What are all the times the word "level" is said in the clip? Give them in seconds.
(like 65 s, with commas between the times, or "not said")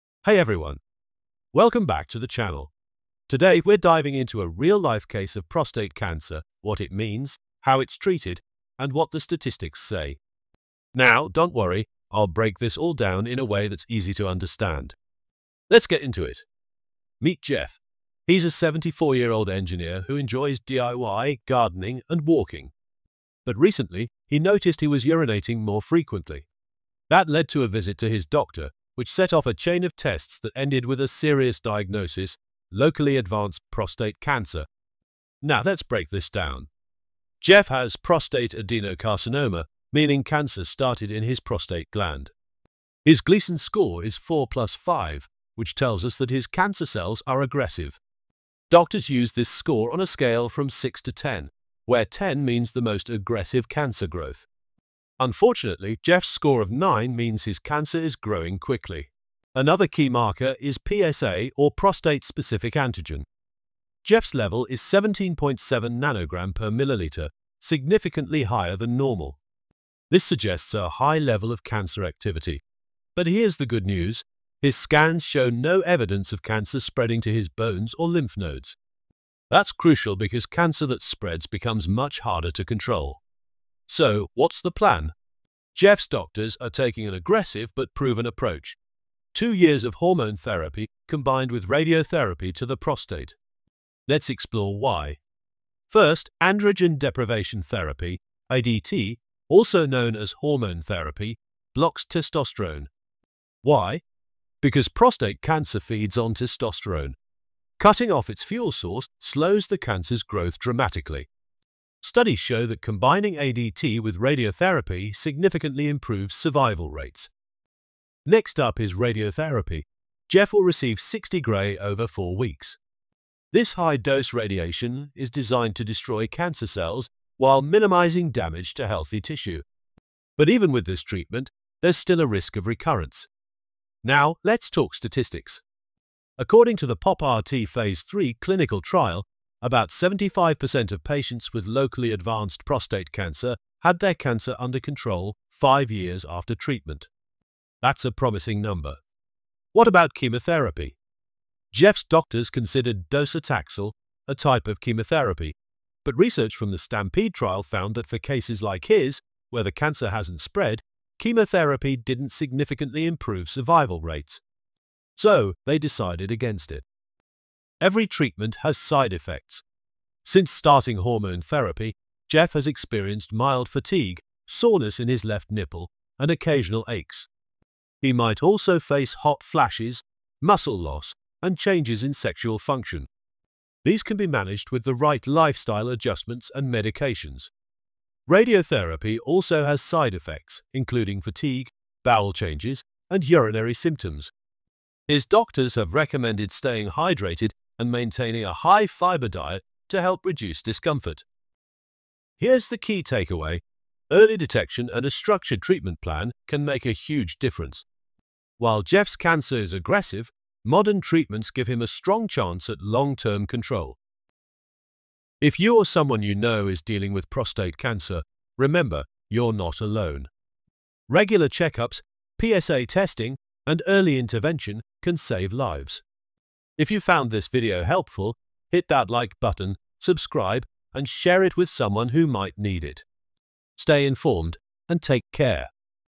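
64 s, 71 s.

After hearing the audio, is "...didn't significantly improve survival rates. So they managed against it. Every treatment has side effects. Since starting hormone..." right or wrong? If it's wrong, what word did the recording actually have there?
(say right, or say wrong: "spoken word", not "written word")
wrong: "decided", not "managed".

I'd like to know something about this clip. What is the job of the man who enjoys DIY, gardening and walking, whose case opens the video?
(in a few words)
Engineer.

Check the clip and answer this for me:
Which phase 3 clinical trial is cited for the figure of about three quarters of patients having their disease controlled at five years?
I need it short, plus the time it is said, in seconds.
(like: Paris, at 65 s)
POP-RT, at 136 s.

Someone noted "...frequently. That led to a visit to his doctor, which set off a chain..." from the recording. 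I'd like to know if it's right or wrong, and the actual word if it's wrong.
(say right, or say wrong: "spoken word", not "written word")
right.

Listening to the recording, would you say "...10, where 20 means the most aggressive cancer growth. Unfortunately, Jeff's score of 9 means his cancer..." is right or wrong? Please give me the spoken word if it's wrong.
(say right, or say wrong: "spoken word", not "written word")
wrong: "10", not "20".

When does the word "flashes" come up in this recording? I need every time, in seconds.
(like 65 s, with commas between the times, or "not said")
179 s.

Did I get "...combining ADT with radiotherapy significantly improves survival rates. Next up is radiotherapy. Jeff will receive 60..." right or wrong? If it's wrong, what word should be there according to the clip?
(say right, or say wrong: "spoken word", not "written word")
right.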